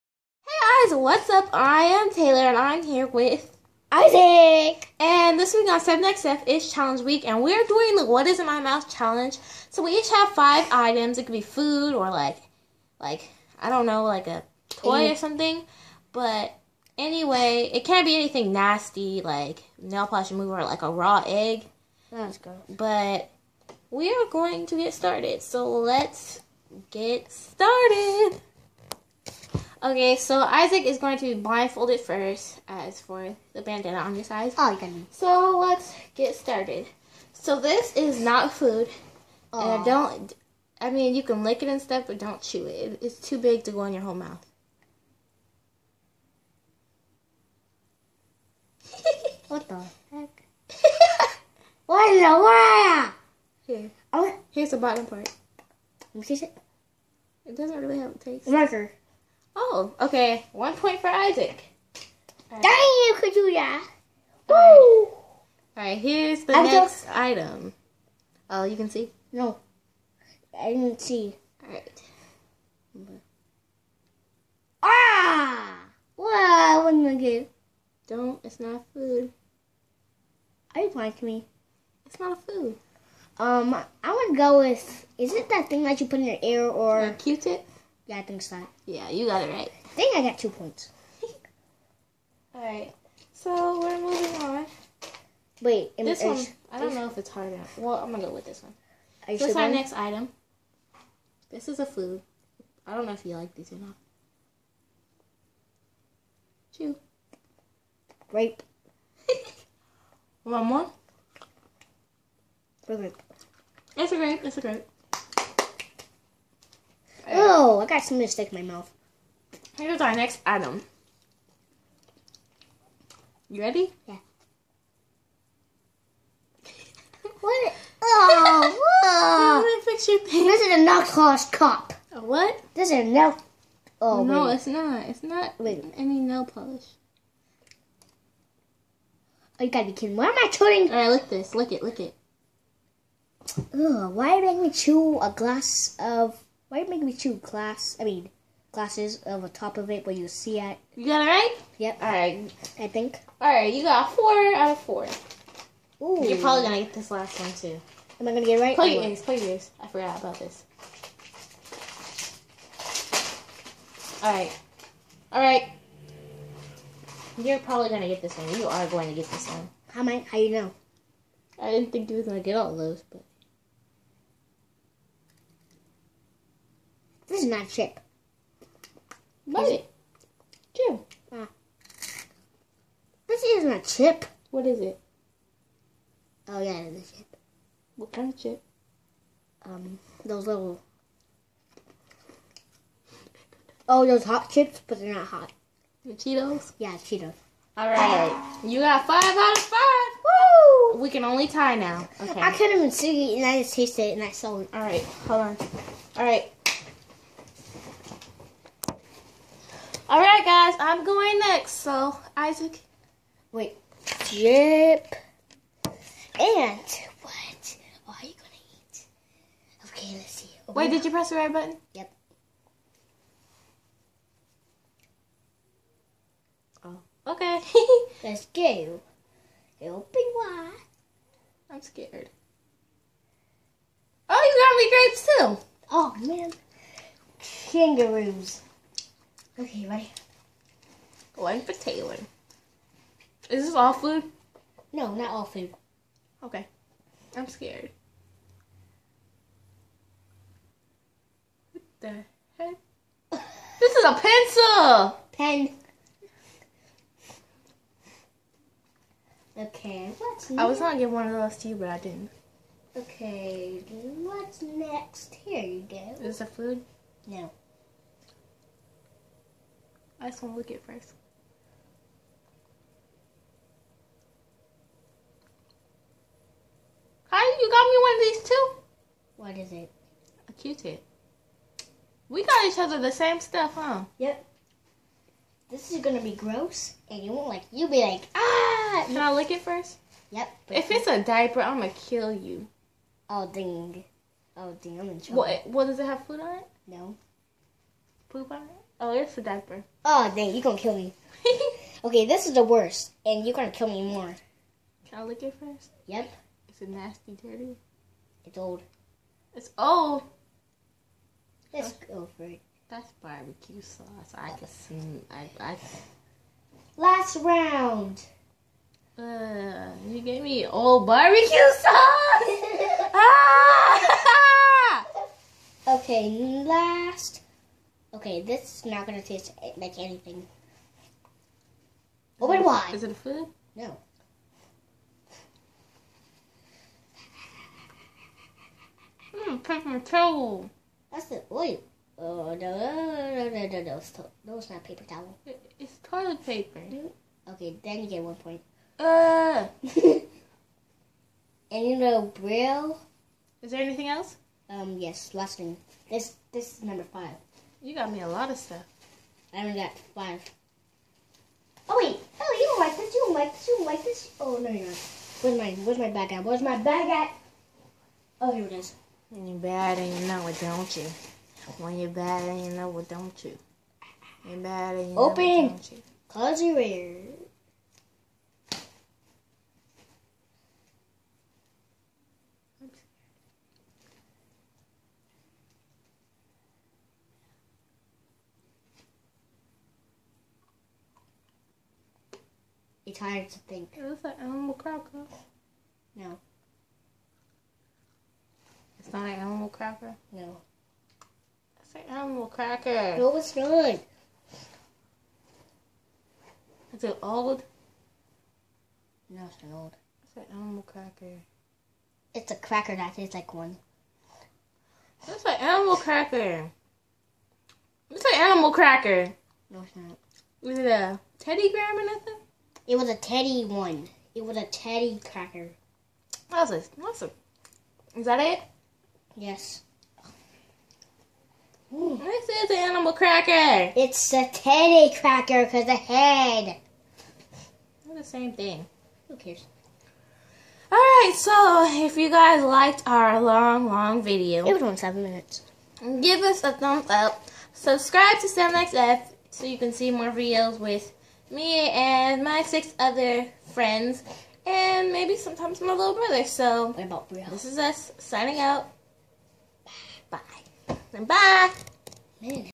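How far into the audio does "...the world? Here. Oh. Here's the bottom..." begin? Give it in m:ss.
0:52.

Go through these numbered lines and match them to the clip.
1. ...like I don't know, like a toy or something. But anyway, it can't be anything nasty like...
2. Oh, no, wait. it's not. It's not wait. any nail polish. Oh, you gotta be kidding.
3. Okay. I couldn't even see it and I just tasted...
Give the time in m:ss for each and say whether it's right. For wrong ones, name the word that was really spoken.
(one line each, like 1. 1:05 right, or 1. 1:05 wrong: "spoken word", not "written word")
1. 0:12 right
2. 2:13 right
3. 3:22 right.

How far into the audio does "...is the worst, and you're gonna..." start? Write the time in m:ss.
5:02.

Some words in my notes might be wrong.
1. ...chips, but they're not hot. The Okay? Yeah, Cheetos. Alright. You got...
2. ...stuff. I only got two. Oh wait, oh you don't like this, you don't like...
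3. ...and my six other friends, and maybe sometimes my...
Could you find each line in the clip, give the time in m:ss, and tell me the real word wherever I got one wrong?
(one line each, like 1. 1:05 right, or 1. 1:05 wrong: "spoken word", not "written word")
1. 3:14 wrong: "Cheetos", not "Okay"
2. 5:58 wrong: "five", not "two"
3. 7:31 right.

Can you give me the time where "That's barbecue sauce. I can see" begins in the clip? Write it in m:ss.
5:12.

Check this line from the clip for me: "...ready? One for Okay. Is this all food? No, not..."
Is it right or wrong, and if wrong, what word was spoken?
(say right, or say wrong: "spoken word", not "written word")
wrong: "Taylor", not "Okay".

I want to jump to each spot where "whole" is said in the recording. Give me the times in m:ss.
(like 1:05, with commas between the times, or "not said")
0:44.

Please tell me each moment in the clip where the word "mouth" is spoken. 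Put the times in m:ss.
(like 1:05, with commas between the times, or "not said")
0:08, 0:44, 1:58.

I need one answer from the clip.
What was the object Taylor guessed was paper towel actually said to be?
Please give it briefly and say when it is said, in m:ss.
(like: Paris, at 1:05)
Toilet paper, at 5:46.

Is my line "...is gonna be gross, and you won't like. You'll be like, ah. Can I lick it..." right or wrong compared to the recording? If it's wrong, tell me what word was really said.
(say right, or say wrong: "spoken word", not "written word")
right.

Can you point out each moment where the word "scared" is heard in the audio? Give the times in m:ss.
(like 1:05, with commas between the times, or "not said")
3:51, 4:07.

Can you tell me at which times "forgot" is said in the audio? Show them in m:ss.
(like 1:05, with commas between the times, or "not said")
2:39.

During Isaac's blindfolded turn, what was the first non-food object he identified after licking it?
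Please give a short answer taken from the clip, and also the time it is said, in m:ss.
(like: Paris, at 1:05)
Marker, at 0:58.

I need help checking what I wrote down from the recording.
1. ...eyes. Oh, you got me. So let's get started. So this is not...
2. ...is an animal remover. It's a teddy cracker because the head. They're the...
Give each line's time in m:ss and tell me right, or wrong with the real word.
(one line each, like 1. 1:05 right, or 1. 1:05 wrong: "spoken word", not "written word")
1. 0:34 right
2. 7:12 wrong: "cracker", not "remover".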